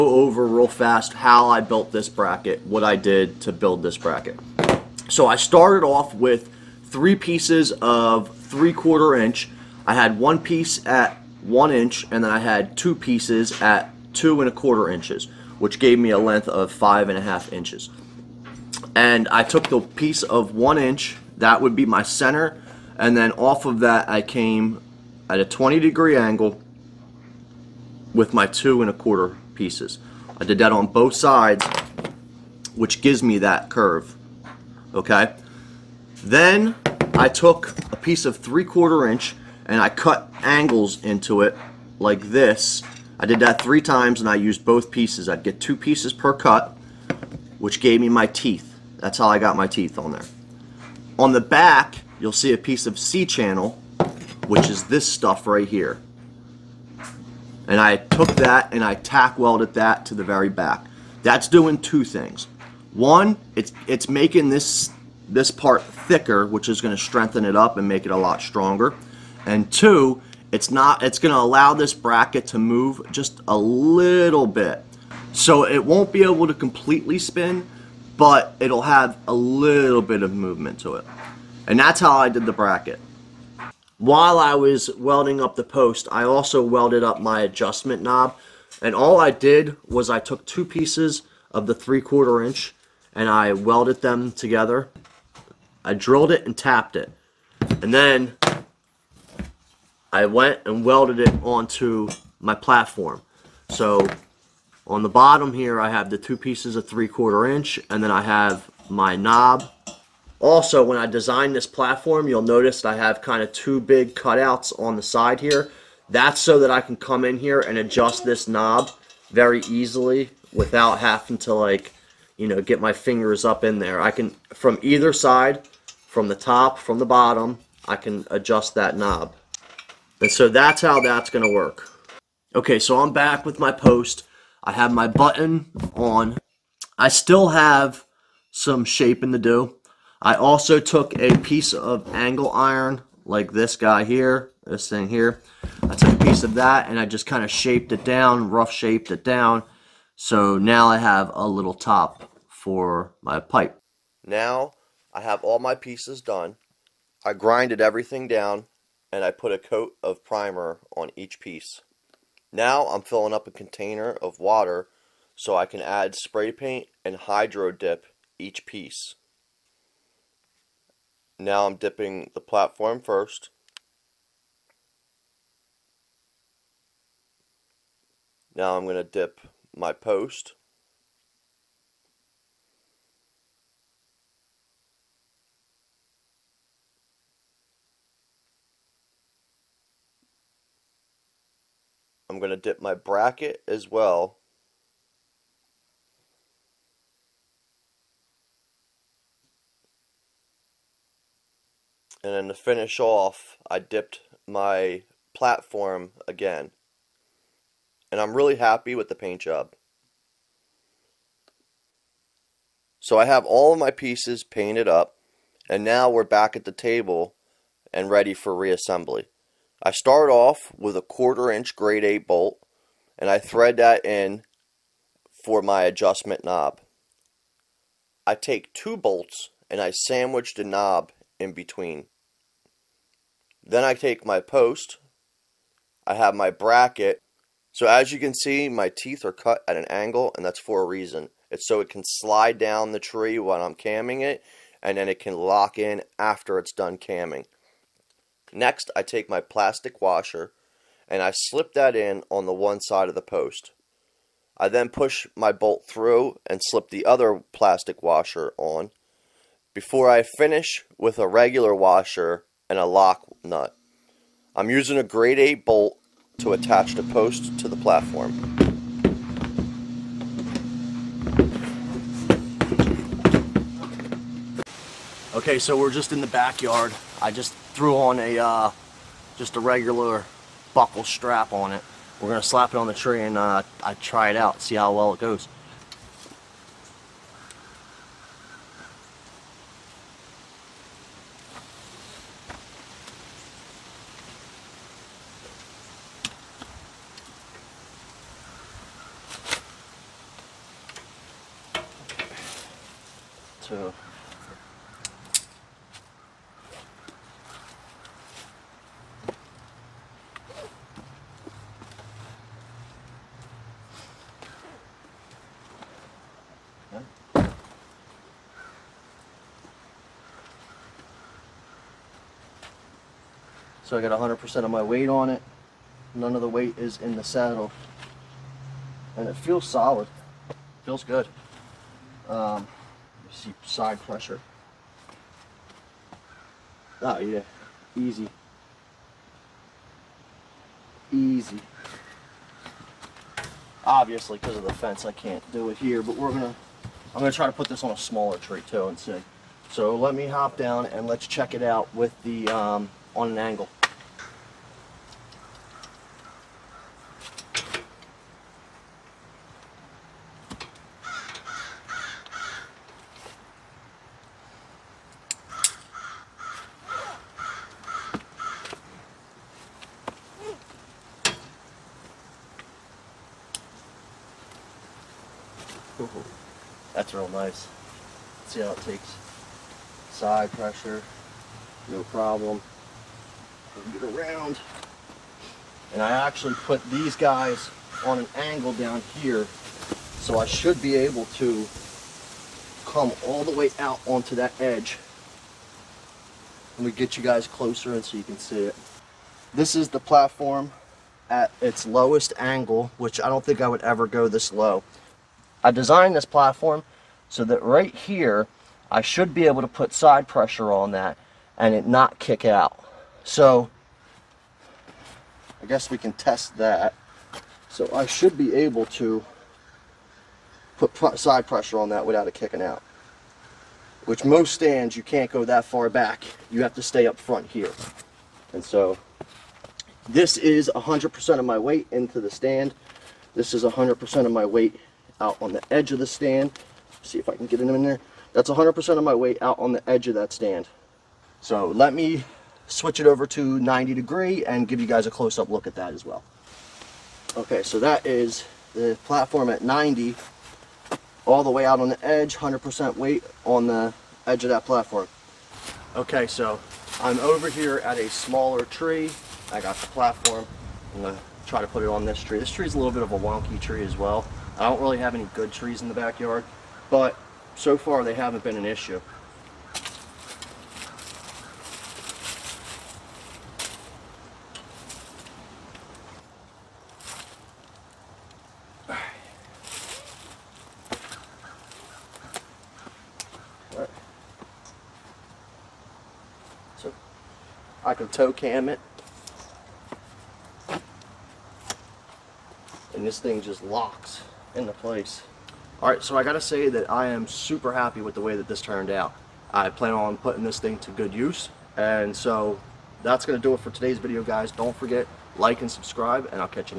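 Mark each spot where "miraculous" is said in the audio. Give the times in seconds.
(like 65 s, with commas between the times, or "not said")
not said.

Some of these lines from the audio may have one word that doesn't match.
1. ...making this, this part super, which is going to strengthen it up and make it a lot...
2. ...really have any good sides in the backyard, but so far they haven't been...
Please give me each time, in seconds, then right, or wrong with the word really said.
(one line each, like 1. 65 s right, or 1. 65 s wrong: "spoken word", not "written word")
1. 64 s wrong: "thicker", not "super"
2. 464 s wrong: "trees", not "sides".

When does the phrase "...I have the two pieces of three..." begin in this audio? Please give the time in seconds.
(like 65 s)
105 s.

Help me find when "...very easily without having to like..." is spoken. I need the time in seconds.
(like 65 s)
119 s.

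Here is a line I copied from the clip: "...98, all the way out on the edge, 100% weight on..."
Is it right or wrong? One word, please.
wrong.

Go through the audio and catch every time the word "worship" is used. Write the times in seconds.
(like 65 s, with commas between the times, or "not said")
not said.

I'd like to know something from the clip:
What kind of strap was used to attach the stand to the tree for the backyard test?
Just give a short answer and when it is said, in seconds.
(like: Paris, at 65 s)
buckle strap, at 280 s.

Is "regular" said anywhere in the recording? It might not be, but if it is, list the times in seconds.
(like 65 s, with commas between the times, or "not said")
261 s, 279 s.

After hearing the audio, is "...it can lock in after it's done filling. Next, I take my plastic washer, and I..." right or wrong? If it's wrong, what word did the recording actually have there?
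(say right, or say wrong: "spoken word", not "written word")
wrong: "camming", not "filling".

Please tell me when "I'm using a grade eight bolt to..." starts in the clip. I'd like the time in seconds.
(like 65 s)
264 s.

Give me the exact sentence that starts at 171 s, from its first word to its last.
Now I'm dipping the platform first.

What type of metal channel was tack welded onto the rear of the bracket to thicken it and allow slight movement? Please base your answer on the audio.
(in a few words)
C-channel.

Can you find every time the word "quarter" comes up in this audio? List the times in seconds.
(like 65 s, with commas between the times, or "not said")
8 s, 14 s, 28 s, 38 s, 92 s, 107 s, 221 s.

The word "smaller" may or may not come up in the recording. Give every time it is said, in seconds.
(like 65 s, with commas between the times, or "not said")
347 s, 458 s.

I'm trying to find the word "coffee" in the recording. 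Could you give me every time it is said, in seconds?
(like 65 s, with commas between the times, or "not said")
not said.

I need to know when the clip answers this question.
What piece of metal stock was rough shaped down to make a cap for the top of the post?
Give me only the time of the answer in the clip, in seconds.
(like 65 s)
142 s.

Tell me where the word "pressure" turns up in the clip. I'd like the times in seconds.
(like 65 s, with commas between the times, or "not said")
334 s, 380 s, 410 s, 421 s.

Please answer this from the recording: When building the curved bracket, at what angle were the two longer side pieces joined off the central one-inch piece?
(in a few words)
20 degrees.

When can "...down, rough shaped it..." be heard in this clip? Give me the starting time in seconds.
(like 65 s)
148 s.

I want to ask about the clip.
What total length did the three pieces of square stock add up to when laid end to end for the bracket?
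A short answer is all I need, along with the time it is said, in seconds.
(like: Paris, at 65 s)
5.5 inches, at 16 s.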